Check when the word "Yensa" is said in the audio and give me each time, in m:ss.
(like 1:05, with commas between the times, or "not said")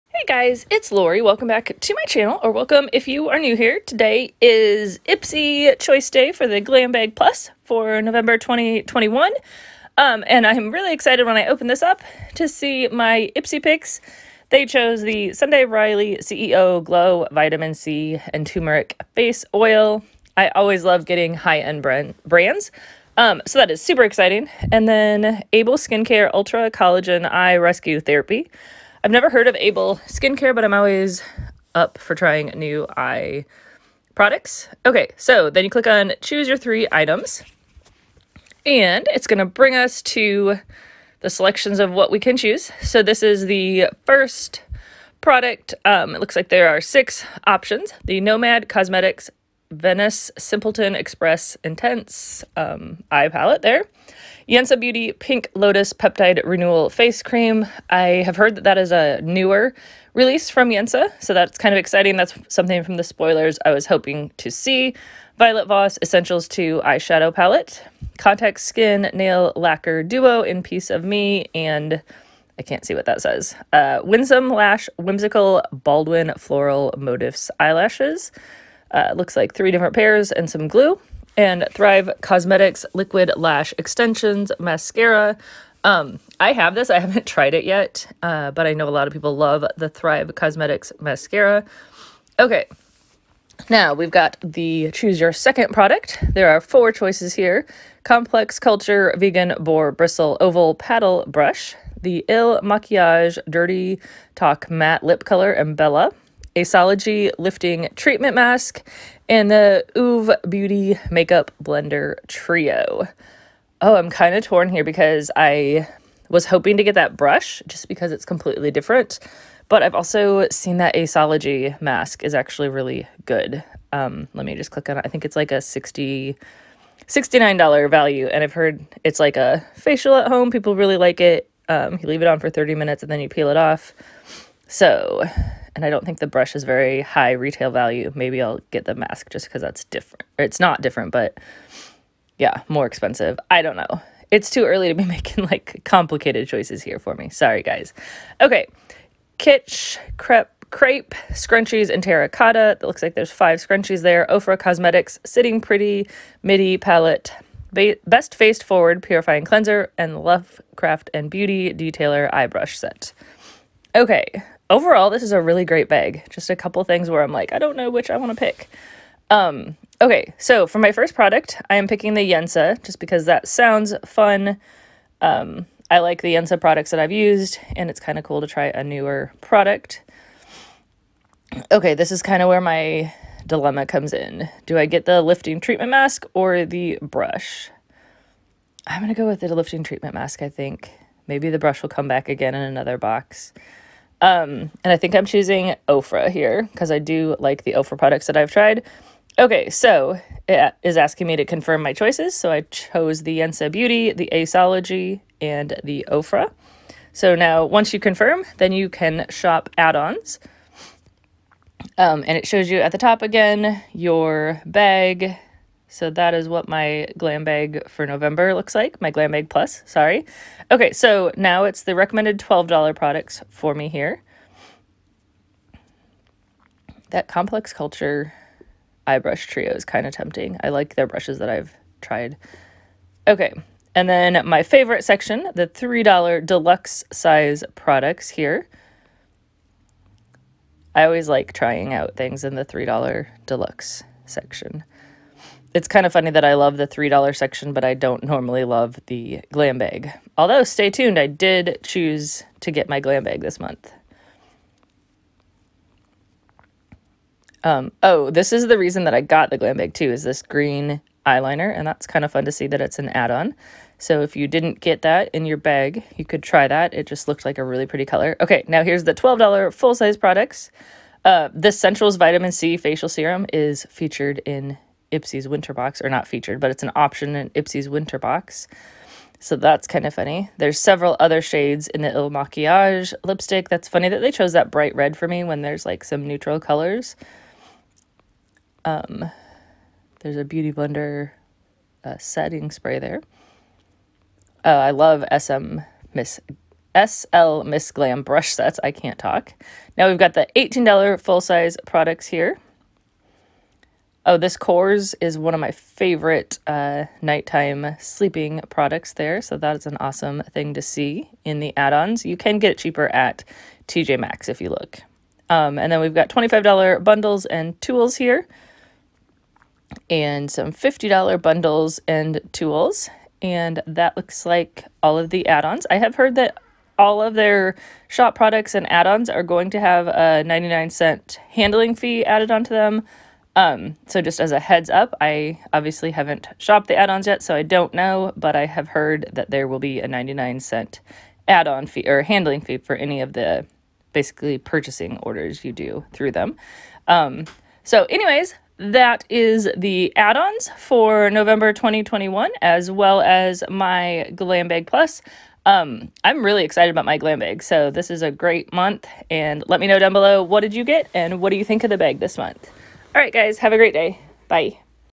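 0:54, 1:00, 2:52, 2:56, 3:23.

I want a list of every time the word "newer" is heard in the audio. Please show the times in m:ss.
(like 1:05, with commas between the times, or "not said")
0:59, 2:58.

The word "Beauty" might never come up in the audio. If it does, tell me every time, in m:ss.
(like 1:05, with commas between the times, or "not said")
0:54, 1:50, 2:41, 3:23, 4:50.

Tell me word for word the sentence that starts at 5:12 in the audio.
You can get it cheaper at TJ Maxx if you look.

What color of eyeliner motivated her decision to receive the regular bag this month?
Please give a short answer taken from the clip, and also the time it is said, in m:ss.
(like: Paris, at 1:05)
Green, at 4:20.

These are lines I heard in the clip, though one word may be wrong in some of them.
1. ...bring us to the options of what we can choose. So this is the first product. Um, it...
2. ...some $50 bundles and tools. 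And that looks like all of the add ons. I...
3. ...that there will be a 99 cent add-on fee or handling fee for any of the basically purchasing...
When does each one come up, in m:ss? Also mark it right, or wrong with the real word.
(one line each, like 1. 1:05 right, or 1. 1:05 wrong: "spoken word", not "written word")
1. 0:39 wrong: "selections", not "options"
2. 5:20 right
3. 5:39 right.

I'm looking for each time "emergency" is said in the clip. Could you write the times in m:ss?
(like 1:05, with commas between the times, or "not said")
not said.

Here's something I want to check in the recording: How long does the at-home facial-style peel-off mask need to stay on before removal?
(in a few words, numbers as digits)
30 minutes.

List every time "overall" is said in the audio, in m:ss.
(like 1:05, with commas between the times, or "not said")
2:44.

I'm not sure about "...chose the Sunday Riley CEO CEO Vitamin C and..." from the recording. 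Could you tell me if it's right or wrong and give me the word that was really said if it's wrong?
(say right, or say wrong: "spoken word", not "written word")
wrong: "Glow", not "CEO".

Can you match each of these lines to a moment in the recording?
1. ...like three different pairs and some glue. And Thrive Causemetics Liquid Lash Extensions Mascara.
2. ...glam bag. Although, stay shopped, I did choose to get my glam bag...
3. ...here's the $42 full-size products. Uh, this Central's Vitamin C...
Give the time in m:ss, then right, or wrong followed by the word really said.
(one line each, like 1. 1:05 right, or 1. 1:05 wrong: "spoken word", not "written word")
1. 1:19 right
2. 4:09 wrong: "tuned", not "shopped"
3. 4:28 wrong: "12", not "42".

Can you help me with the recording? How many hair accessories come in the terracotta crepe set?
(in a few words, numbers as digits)
5.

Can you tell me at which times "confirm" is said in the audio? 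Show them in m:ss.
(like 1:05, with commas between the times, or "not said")
3:21, 3:27.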